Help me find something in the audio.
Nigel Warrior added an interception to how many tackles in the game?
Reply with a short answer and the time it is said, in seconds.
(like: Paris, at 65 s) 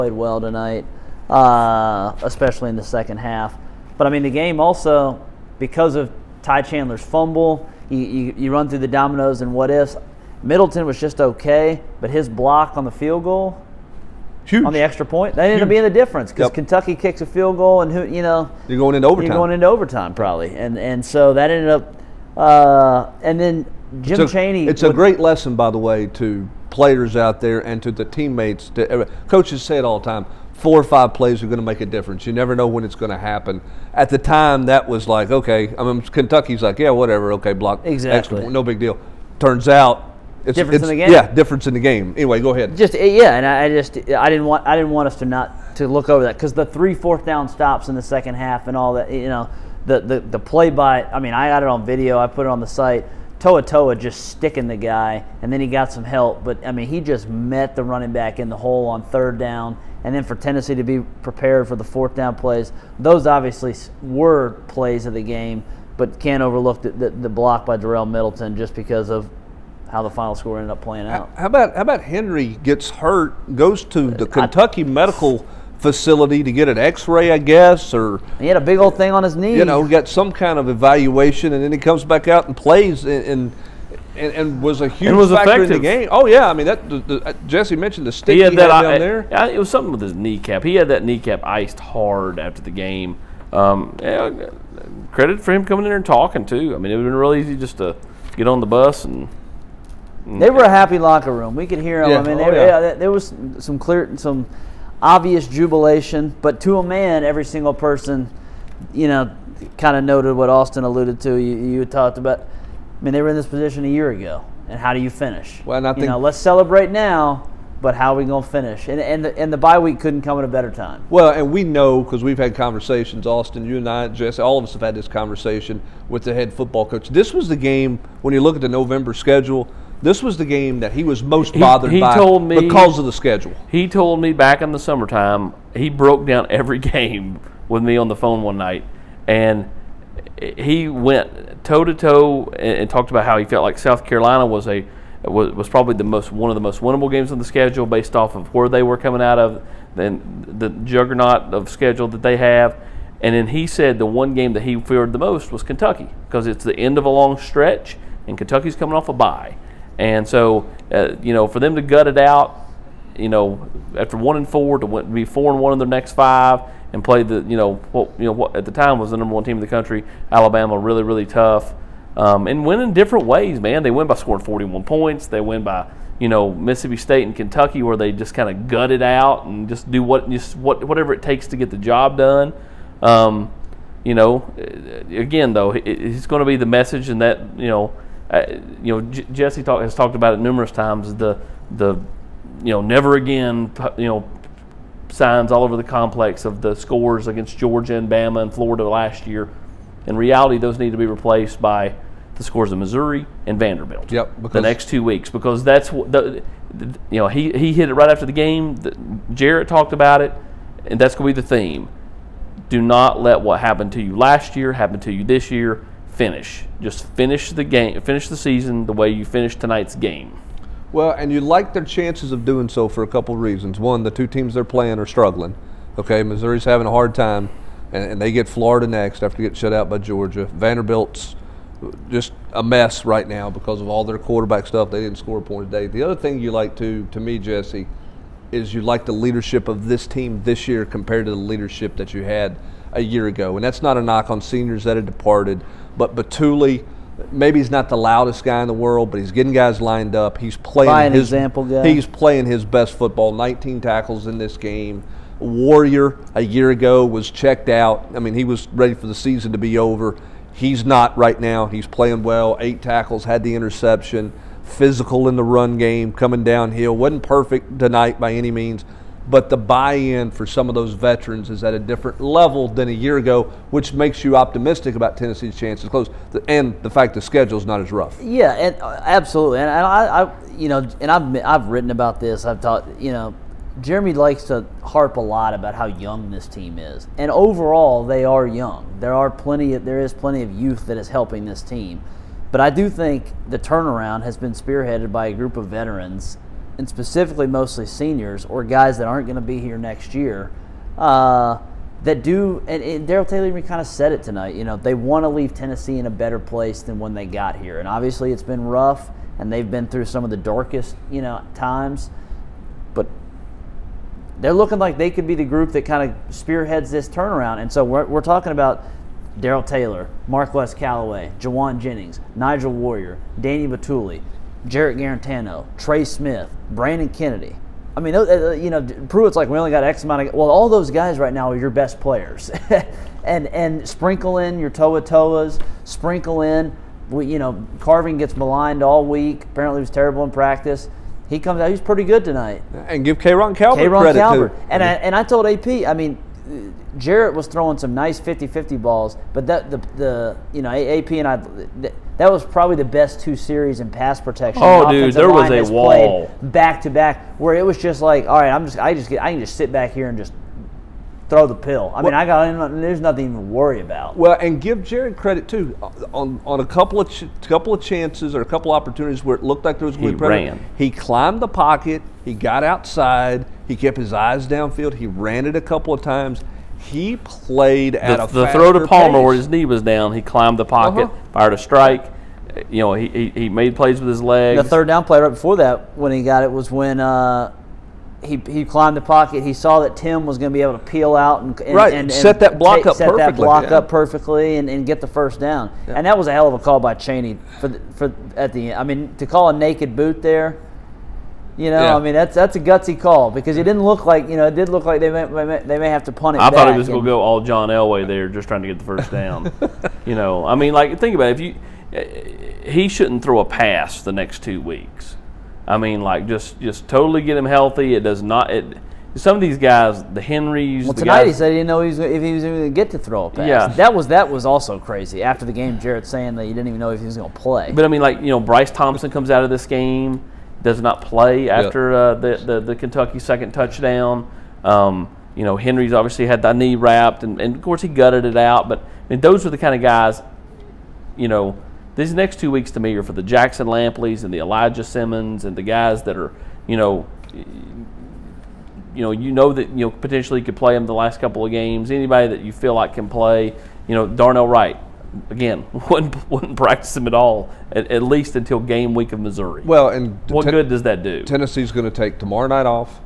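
8, at 262 s.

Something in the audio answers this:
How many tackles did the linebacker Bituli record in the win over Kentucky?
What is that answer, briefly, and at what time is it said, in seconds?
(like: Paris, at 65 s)
19, at 253 s.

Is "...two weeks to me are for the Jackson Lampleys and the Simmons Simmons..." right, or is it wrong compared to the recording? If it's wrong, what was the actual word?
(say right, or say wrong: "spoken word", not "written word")
wrong: "Elijah", not "Simmons".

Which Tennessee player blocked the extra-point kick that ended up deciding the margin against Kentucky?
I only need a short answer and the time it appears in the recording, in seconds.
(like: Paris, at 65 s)
Darel Middleton, at 67 s.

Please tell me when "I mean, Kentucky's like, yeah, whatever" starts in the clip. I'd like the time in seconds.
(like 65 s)
35 s.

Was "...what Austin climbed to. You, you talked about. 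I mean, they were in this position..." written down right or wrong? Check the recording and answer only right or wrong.
wrong.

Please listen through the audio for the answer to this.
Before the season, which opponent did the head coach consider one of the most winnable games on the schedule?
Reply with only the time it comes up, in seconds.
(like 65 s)
143 s.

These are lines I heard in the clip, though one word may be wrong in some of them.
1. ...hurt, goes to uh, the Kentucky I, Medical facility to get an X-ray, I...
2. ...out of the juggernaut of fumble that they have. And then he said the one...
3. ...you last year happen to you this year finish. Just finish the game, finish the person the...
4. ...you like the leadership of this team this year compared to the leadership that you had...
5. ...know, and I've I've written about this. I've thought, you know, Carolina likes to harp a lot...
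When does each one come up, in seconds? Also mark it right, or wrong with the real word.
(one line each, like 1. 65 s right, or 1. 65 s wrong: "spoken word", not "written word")
1. 72 s right
2. 149 s wrong: "schedule", not "fumble"
3. 214 s wrong: "season", not "person"
4. 238 s right
5. 280 s wrong: "Jeremy", not "Carolina".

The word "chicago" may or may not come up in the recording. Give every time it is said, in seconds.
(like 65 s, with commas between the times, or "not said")
not said.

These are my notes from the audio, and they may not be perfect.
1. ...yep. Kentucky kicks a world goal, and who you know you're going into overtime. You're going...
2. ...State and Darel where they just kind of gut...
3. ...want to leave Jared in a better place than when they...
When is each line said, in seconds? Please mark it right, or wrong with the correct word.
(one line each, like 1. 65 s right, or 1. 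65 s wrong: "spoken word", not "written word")
1. 16 s wrong: "field", not "world"
2. 176 s wrong: "Kentucky", not "Darel"
3. 304 s wrong: "Tennessee", not "Jared".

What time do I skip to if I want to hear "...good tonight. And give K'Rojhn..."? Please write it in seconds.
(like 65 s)
342 s.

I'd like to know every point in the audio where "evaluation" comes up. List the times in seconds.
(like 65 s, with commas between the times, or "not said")
80 s.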